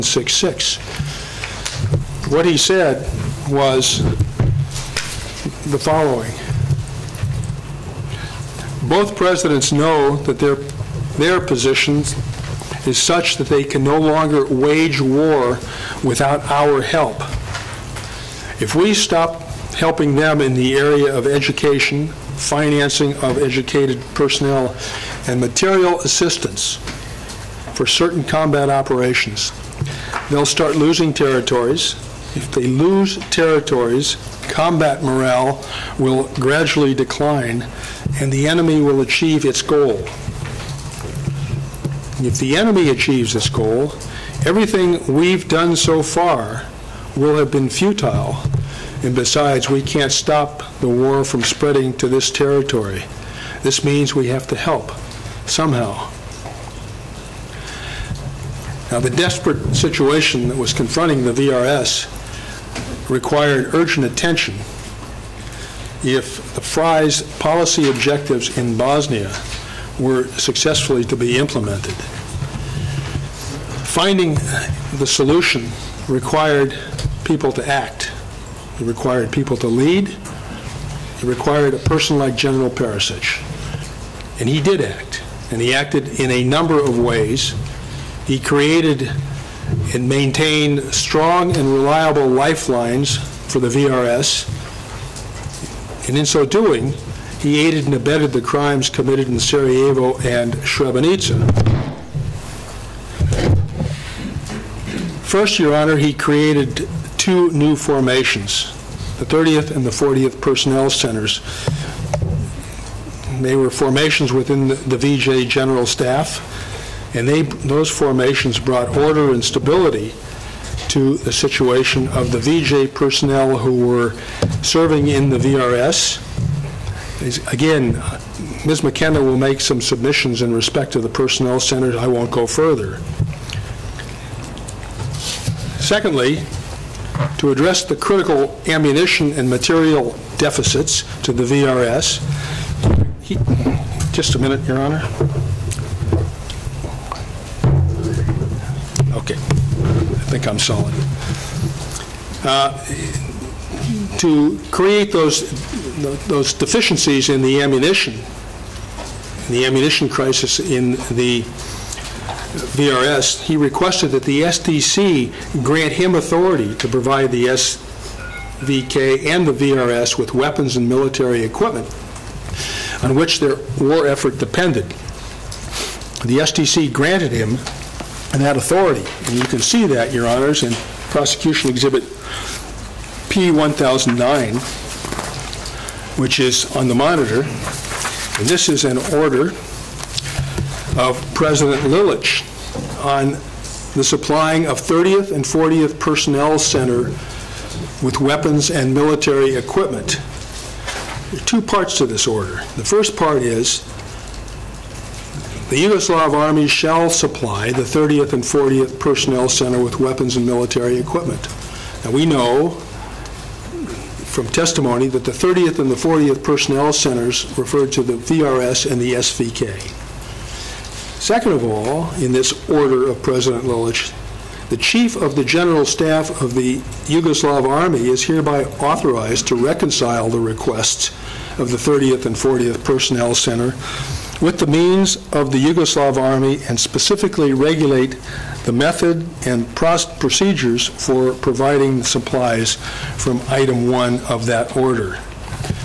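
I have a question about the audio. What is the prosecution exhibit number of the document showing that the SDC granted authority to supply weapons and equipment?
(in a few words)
P1009.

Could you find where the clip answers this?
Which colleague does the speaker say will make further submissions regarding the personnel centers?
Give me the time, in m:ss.
2:08.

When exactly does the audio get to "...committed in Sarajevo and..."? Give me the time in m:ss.
1:38.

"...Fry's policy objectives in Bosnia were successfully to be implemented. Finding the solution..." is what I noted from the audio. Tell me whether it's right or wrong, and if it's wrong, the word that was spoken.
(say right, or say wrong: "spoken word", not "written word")
right.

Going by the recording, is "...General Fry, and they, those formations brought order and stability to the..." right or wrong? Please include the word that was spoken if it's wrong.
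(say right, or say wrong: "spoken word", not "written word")
wrong: "Staff", not "Fry".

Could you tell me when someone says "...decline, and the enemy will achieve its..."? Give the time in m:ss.
0:36.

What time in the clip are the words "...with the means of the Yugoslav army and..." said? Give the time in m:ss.
3:54.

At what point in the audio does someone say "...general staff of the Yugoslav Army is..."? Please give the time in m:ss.
3:45.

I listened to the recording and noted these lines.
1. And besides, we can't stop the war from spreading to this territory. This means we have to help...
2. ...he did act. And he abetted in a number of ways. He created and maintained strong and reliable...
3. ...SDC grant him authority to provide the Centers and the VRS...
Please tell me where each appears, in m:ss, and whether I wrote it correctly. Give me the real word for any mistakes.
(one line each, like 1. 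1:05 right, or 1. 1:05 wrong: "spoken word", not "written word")
1. 0:49 right
2. 1:24 wrong: "acted", not "abetted"
3. 2:44 wrong: "SVK", not "Centers".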